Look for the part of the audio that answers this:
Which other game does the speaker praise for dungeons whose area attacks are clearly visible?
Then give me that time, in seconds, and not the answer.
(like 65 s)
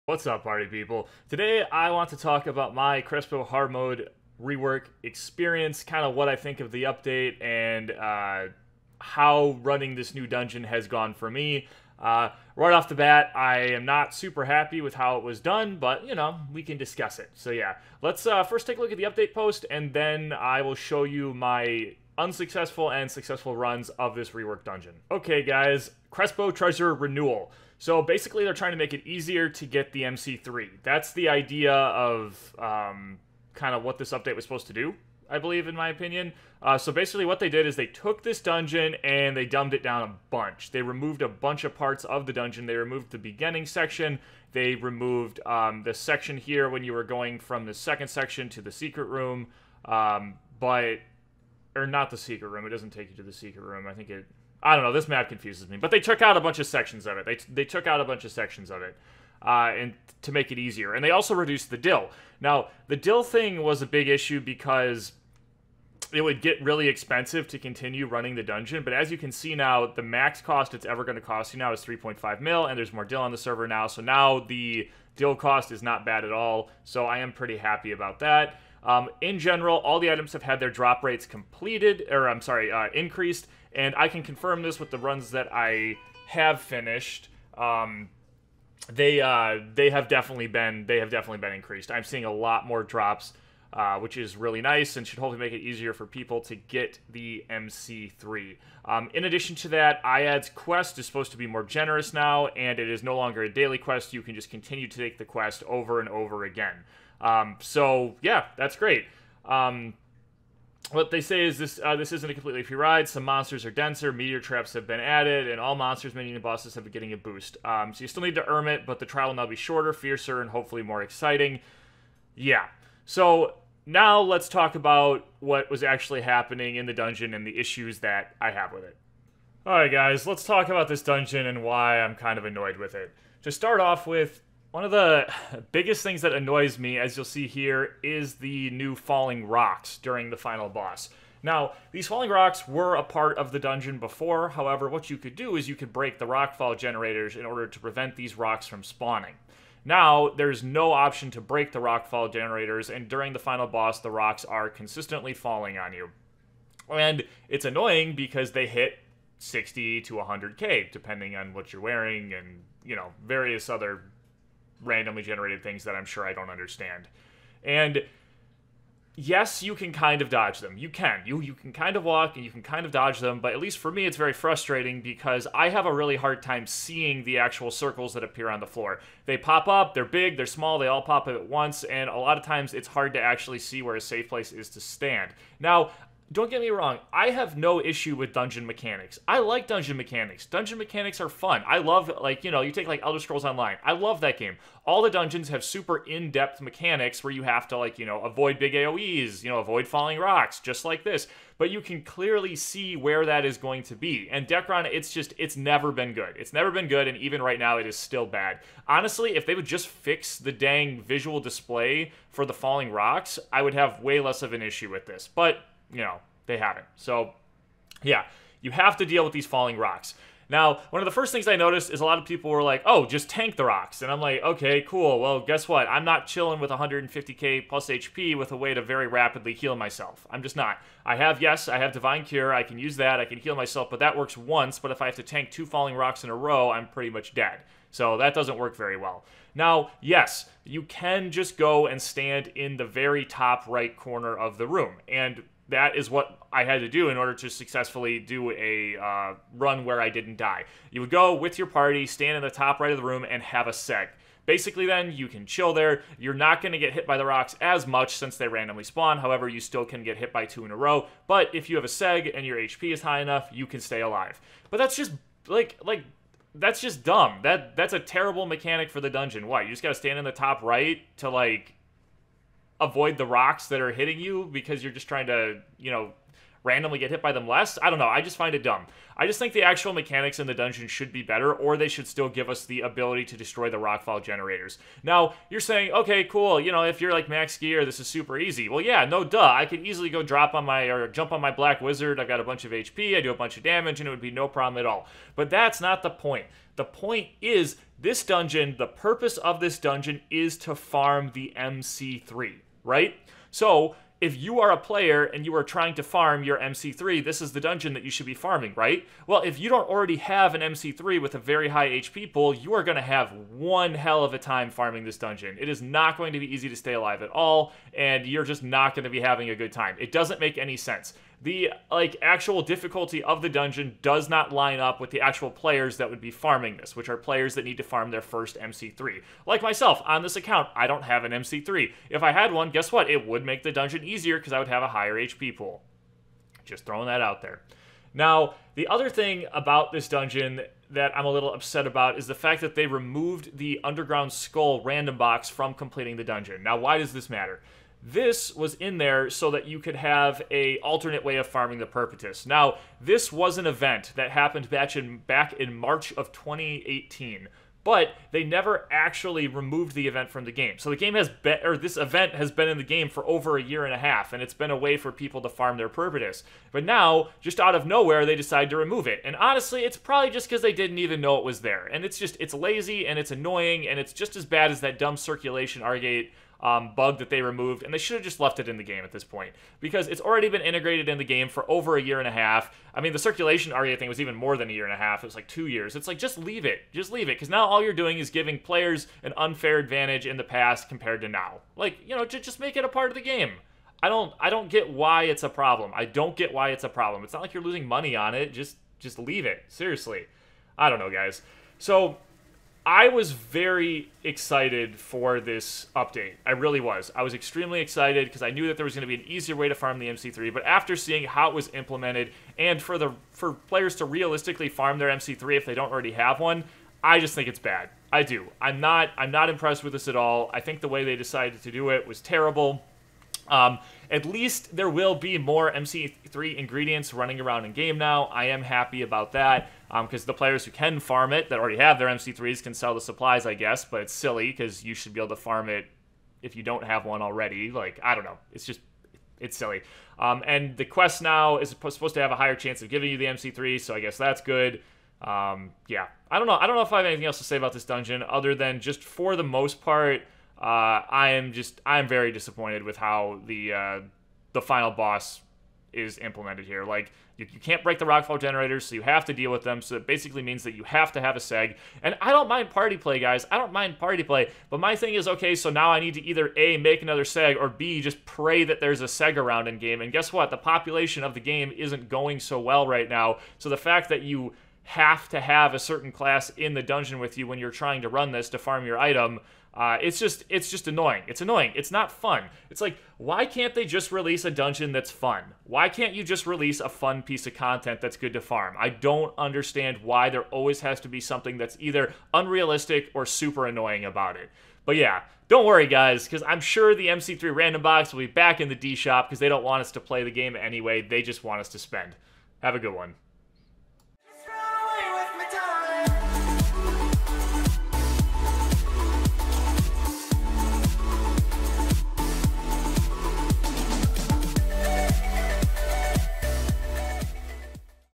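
193 s.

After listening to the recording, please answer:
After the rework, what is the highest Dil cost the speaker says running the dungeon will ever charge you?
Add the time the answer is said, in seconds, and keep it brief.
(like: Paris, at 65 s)
3.5 million, at 71 s.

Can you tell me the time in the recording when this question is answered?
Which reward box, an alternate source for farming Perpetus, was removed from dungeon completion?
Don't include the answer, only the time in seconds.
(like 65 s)
343 s.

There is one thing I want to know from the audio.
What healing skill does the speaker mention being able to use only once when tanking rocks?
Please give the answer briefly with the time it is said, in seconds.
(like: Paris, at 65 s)
Divine Cure, at 231 s.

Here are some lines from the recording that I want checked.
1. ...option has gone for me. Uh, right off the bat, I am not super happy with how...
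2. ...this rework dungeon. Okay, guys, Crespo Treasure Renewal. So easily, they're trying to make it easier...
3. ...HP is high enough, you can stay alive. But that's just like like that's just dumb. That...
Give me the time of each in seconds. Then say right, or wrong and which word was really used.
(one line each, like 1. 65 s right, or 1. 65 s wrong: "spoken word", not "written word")
1. 10 s wrong: "dungeon", not "option"
2. 24 s wrong: "basically", not "easily"
3. 262 s right.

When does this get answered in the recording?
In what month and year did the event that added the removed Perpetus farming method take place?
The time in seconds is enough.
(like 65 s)
355 s.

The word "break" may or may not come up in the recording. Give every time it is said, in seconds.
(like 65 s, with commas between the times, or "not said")
145 s, 151 s, 457 s.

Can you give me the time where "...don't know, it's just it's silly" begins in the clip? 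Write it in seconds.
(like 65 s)
438 s.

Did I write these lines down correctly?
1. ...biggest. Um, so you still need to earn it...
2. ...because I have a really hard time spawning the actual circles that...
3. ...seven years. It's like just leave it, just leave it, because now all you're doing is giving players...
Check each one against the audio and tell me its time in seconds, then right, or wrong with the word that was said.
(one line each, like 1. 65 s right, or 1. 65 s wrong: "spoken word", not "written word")
1. 117 s wrong: "boost", not "biggest"
2. 175 s wrong: "seeing", not "spawning"
3. 385 s wrong: "two", not "seven".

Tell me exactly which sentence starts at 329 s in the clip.
Like myself, on this account, I don't have an MC3.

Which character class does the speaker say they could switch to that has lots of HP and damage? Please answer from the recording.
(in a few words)
Black Wizard.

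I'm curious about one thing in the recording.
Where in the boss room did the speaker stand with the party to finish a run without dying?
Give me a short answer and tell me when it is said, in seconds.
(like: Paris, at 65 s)
top right corner, at 242 s.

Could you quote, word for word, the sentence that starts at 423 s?
Um, at least there will be more MC3 ingredients running around in game now.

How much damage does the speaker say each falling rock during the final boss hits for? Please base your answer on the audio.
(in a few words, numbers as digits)
60 to 100k.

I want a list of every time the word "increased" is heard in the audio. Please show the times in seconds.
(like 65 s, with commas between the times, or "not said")
82 s, 91 s.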